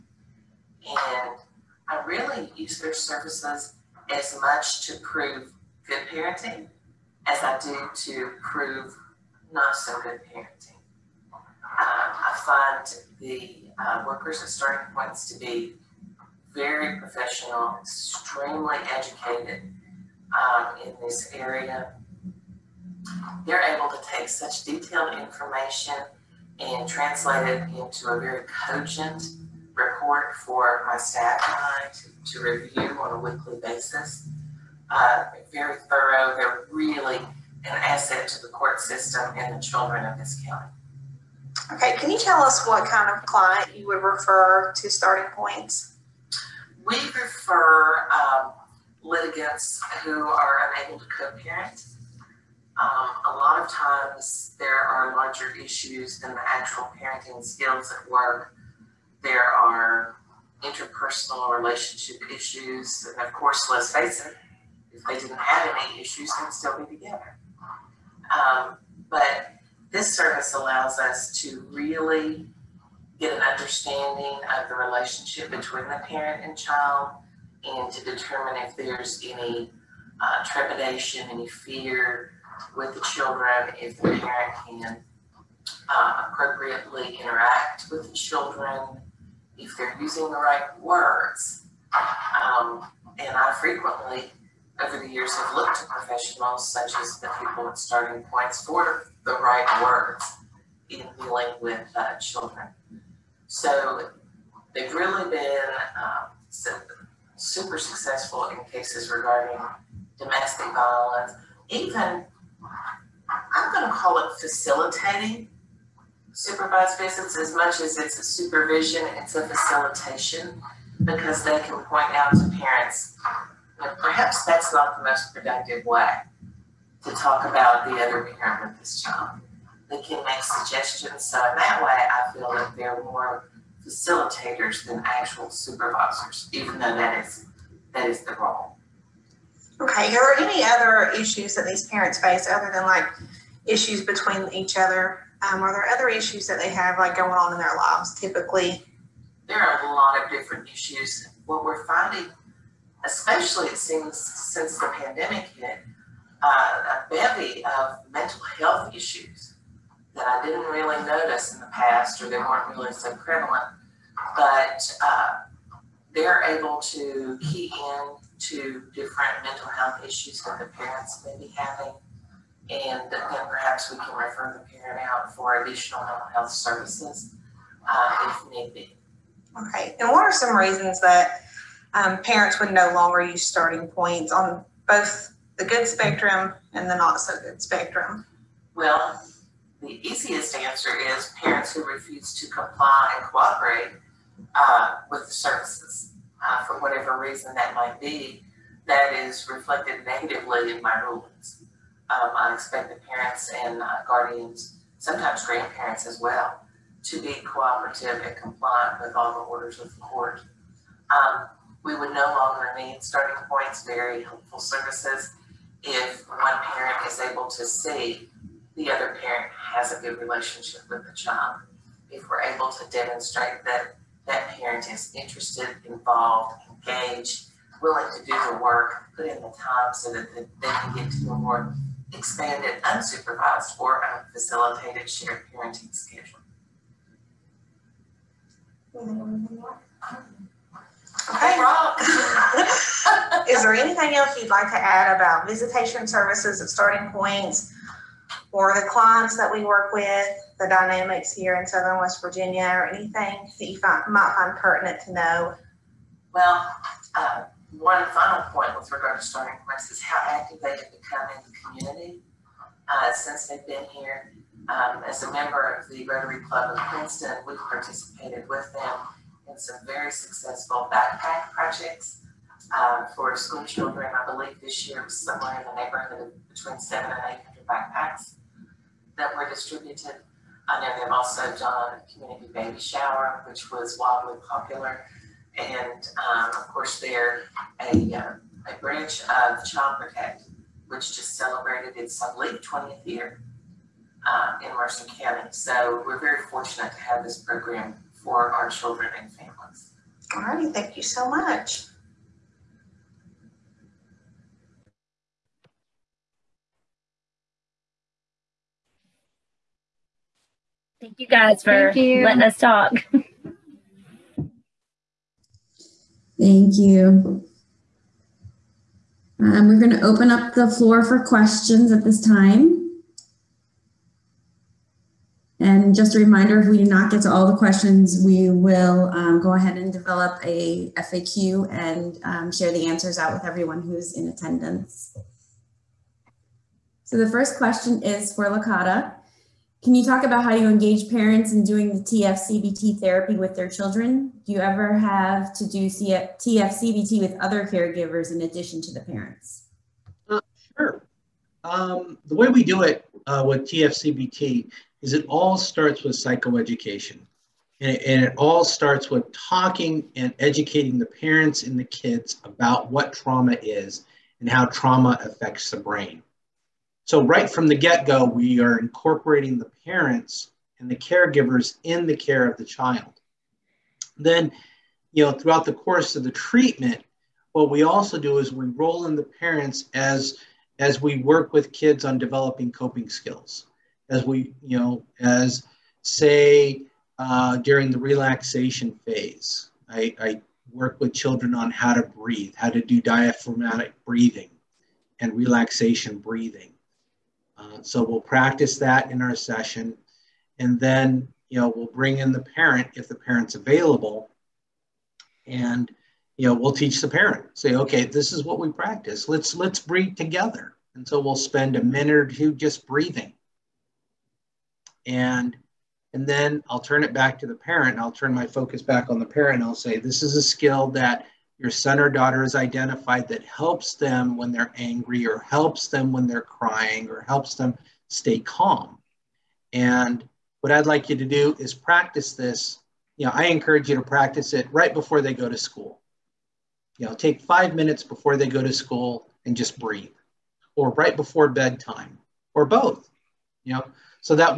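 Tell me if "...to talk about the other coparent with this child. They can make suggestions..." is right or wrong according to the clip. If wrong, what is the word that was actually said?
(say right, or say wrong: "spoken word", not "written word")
wrong: "parent", not "coparent".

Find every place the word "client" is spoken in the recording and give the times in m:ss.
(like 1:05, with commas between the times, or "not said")
0:43, 4:08.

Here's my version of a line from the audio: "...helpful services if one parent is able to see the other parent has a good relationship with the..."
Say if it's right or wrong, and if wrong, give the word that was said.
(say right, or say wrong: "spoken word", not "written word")
right.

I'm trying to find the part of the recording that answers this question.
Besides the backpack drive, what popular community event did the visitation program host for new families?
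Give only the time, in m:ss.
4:42.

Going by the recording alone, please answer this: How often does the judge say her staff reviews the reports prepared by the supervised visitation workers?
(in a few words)
Weekly.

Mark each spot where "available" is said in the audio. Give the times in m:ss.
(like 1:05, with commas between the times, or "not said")
6:43.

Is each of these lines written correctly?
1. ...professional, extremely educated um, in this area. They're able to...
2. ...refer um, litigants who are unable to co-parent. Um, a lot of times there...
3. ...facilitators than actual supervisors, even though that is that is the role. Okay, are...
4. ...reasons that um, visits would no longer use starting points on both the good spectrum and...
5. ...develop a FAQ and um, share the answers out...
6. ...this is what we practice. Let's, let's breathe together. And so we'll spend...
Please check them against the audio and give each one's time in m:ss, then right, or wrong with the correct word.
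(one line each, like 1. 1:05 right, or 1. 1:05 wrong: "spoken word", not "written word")
1. 0:16 right
2. 0:46 right
3. 2:13 right
4. 3:00 wrong: "parents", not "visits"
5. 5:29 right
6. 6:48 right.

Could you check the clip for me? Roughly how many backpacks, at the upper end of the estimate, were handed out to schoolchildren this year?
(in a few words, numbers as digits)
800.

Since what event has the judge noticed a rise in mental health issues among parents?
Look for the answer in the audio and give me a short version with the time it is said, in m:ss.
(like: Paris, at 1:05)
The pandemic, at 2:34.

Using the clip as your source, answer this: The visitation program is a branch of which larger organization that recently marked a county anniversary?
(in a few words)
Child Protect.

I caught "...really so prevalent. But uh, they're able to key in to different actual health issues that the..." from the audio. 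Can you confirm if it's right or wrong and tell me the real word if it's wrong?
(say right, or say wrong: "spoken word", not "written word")
wrong: "mental", not "actual".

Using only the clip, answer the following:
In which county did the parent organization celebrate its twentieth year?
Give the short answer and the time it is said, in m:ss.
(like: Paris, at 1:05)
Mercer County, at 4:54.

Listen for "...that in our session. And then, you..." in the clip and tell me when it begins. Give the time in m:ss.
6:38.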